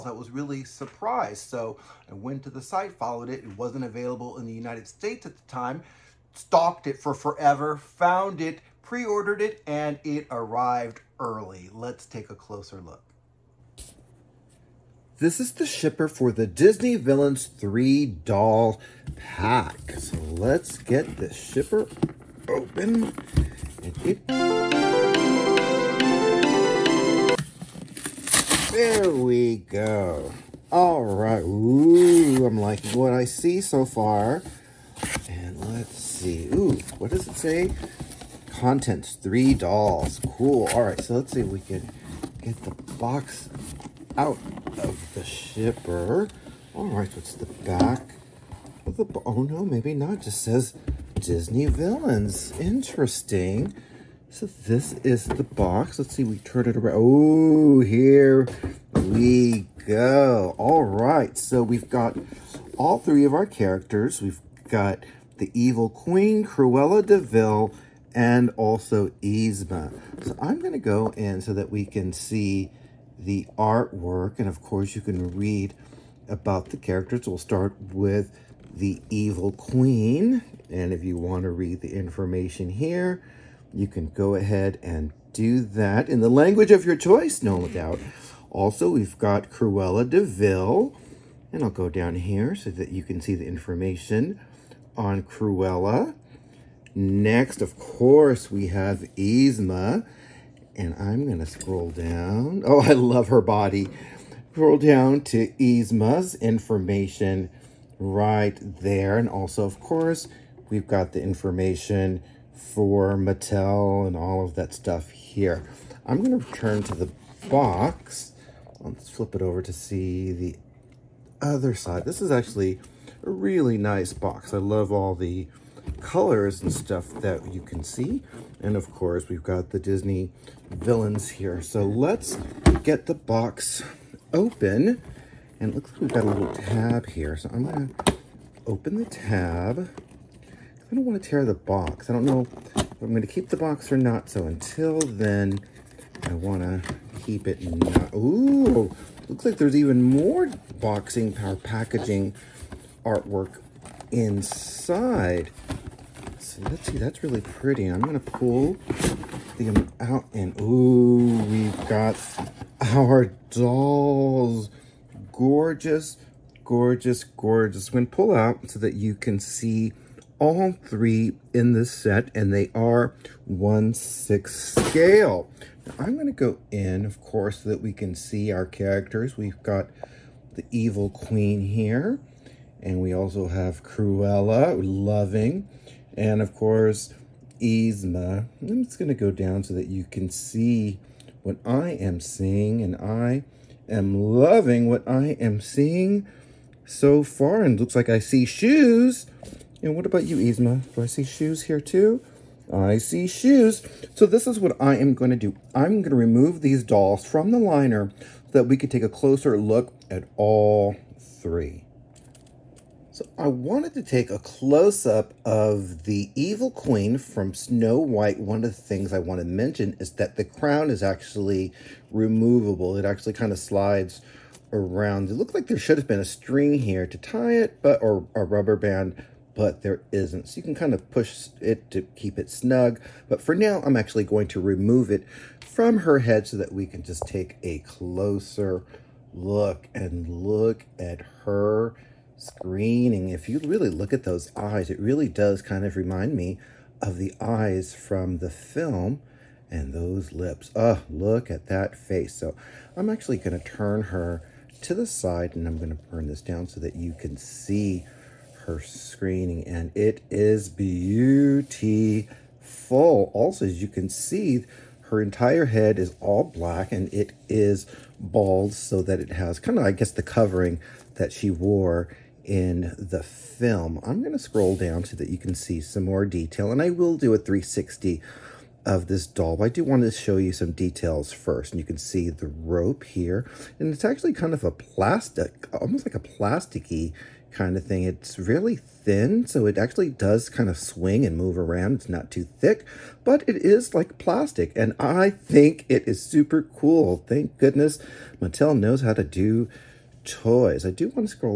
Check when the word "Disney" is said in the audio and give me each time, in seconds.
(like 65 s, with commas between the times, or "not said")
16 s, 51 s, 129 s.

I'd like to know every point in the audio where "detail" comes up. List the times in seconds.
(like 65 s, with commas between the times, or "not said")
276 s, 280 s.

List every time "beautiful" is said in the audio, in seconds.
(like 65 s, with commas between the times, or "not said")
260 s.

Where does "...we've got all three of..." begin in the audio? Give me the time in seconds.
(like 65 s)
61 s.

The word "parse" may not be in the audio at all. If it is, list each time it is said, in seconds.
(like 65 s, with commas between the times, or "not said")
not said.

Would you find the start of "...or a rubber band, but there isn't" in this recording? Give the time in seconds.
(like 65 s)
228 s.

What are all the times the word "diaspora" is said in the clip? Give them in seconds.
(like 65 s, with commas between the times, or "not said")
not said.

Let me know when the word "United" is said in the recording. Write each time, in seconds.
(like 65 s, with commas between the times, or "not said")
4 s.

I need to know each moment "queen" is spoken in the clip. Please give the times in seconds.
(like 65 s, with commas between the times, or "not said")
65 s, 79 s, 181 s, 216 s.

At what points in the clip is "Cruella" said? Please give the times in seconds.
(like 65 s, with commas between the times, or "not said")
66 s, 89 s, 95 s, 183 s.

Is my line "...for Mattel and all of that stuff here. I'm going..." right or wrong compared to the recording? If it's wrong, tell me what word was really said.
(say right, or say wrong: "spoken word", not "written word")
right.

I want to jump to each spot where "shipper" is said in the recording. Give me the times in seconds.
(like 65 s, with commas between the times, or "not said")
15 s, 21 s, 45 s.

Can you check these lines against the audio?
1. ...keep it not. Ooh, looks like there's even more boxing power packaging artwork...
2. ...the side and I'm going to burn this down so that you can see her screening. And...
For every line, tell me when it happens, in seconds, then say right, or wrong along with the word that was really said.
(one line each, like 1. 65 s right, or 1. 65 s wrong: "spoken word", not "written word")
1. 147 s right
2. 254 s right.